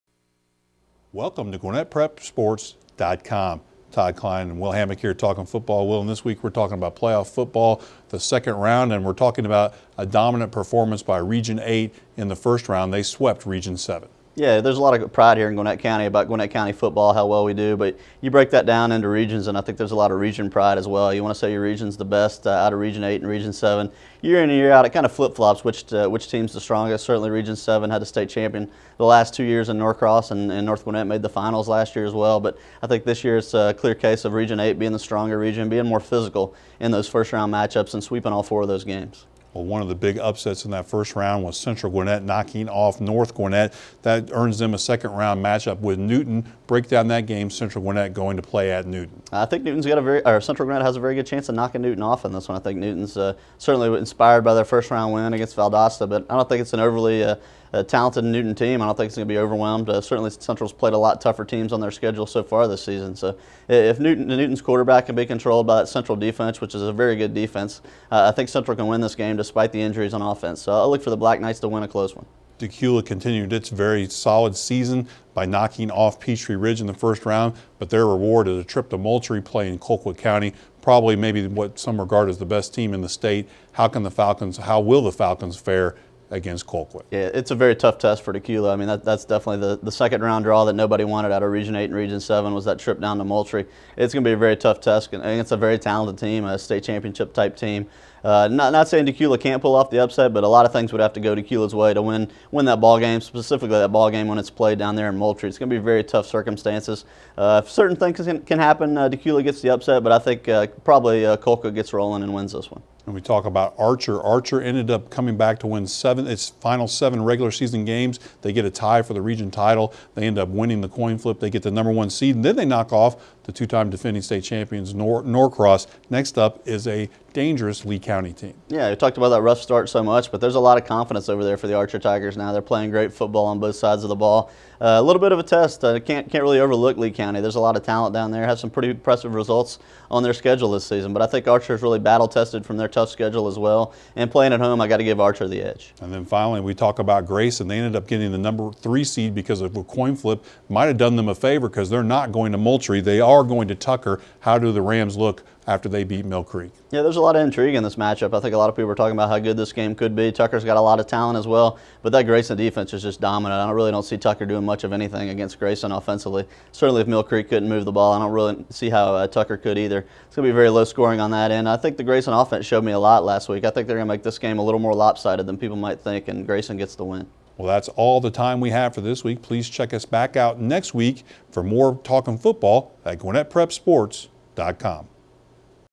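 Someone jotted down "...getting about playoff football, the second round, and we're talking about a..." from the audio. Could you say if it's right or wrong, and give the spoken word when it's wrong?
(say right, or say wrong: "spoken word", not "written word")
wrong: "talking", not "getting".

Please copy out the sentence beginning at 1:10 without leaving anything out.
So, I look for the Black Knights to win a close one.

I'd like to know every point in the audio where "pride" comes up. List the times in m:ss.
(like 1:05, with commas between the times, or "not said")
0:15, 0:20.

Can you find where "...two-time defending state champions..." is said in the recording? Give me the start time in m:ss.
2:03.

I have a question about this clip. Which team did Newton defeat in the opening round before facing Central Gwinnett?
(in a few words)
Valdosta.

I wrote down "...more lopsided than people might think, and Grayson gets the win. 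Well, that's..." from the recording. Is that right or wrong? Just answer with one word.
right.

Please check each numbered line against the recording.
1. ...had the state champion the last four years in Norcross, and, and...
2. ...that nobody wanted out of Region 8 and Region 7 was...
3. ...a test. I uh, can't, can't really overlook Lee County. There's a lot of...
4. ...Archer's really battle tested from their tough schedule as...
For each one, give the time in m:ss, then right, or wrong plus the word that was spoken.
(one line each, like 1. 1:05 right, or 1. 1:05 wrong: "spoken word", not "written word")
1. 0:27 wrong: "two", not "four"
2. 1:30 right
3. 2:15 right
4. 2:21 right.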